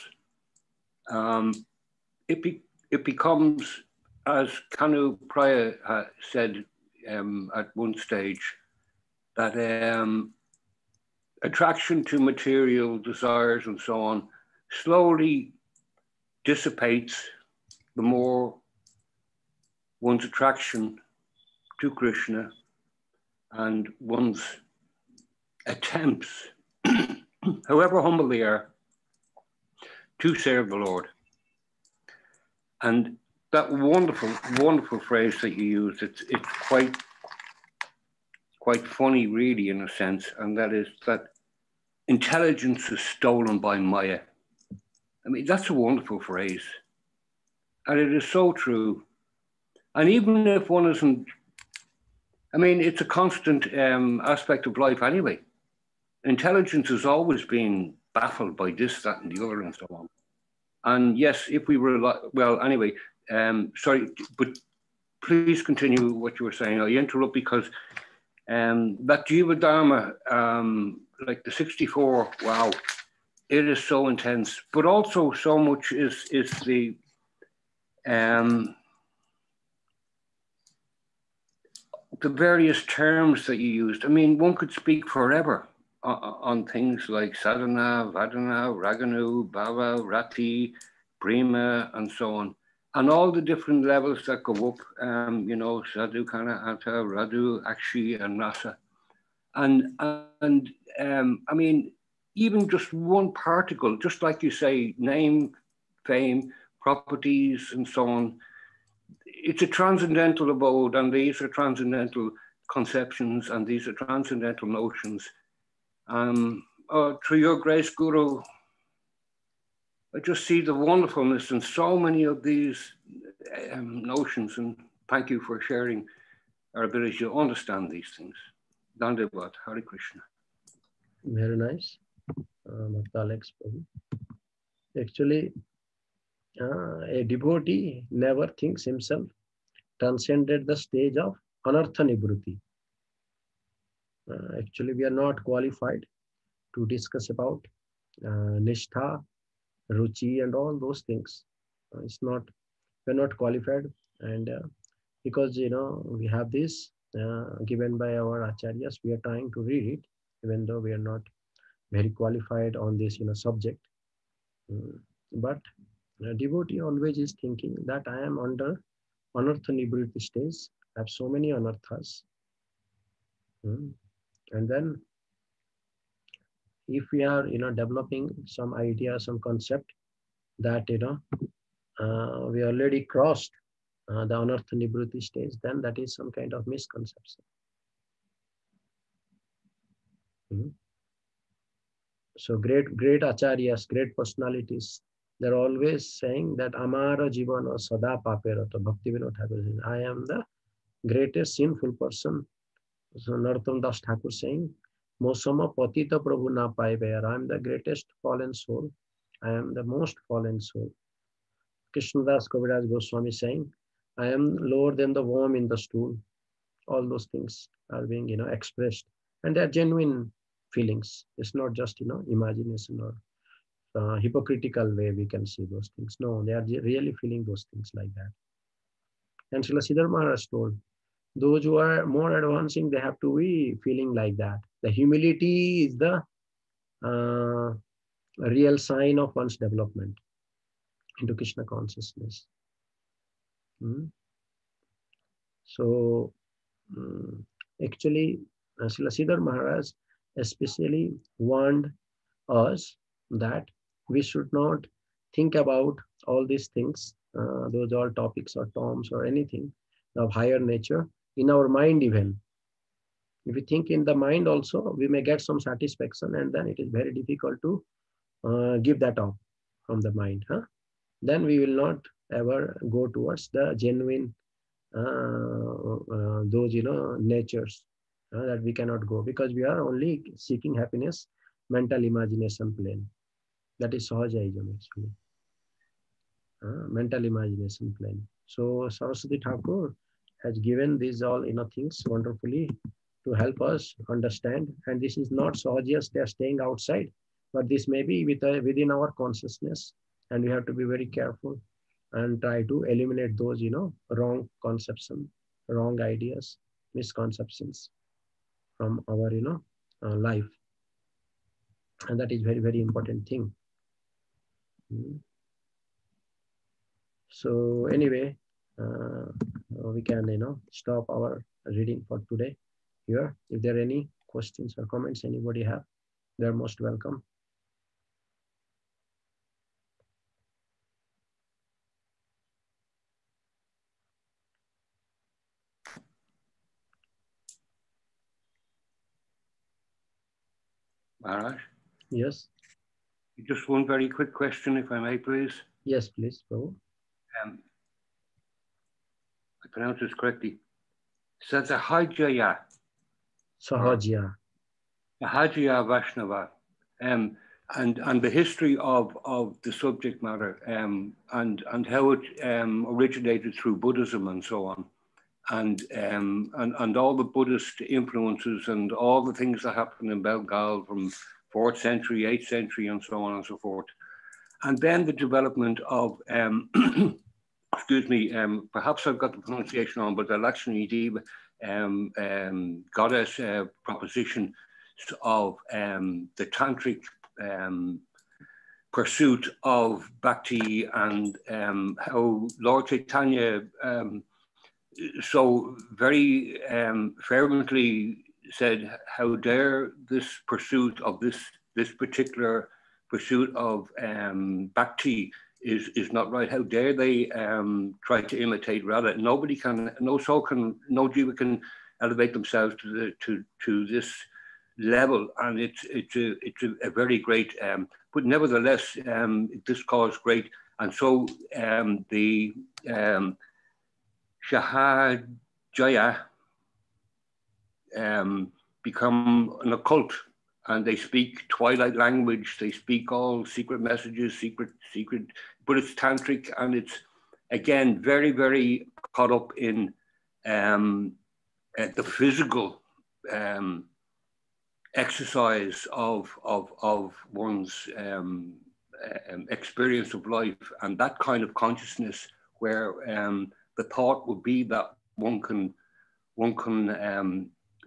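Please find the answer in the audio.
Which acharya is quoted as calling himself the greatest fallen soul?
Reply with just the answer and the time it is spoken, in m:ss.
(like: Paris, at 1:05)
Narottam Das Thakur, at 3:23.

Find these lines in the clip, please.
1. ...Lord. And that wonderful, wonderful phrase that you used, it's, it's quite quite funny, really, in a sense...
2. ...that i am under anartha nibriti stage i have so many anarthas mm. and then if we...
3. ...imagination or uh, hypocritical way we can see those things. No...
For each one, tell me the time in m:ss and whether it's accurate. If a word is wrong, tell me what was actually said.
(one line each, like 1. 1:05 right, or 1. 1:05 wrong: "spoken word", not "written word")
1. 0:30 right
2. 2:47 right
3. 3:42 right.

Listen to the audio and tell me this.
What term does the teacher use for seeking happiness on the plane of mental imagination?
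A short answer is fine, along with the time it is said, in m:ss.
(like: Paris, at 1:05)
Sahajayam, at 4:44.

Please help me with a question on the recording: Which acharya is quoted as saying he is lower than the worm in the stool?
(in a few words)
Krishnadas Kaviraj Goswami.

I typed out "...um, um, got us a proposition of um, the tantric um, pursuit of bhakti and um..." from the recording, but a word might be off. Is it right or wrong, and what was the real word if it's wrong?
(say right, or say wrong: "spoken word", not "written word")
right.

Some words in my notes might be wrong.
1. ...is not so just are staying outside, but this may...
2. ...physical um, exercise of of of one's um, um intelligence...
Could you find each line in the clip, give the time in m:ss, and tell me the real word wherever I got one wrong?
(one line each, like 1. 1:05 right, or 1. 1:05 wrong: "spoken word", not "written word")
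1. 4:55 right
2. 7:22 wrong: "experience", not "intelligence".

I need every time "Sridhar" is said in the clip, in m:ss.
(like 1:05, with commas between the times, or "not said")
3:49, 4:08.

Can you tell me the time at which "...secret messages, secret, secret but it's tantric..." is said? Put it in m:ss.
7:13.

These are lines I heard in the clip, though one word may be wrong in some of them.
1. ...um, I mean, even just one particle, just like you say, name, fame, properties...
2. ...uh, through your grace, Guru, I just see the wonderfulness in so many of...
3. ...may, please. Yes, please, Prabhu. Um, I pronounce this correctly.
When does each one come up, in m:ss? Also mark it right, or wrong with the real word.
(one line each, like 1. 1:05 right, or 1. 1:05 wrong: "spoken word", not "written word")
1. 1:40 right
2. 1:56 right
3. 5:44 right.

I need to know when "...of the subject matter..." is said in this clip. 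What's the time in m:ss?
5:59.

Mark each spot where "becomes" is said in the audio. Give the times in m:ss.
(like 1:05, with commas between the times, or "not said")
0:03, 7:08.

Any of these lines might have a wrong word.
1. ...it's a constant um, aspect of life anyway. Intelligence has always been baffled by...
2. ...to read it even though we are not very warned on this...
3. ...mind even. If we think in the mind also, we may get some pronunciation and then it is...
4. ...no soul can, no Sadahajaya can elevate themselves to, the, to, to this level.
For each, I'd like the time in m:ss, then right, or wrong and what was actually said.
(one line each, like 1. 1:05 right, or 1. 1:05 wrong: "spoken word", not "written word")
1. 0:52 right
2. 2:39 wrong: "qualified", not "warned"
3. 4:21 wrong: "satisfaction", not "pronunciation"
4. 6:50 wrong: "Jew", not "Sadahajaya".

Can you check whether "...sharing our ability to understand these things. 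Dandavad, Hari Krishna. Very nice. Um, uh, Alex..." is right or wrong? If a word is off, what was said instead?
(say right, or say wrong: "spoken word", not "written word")
right.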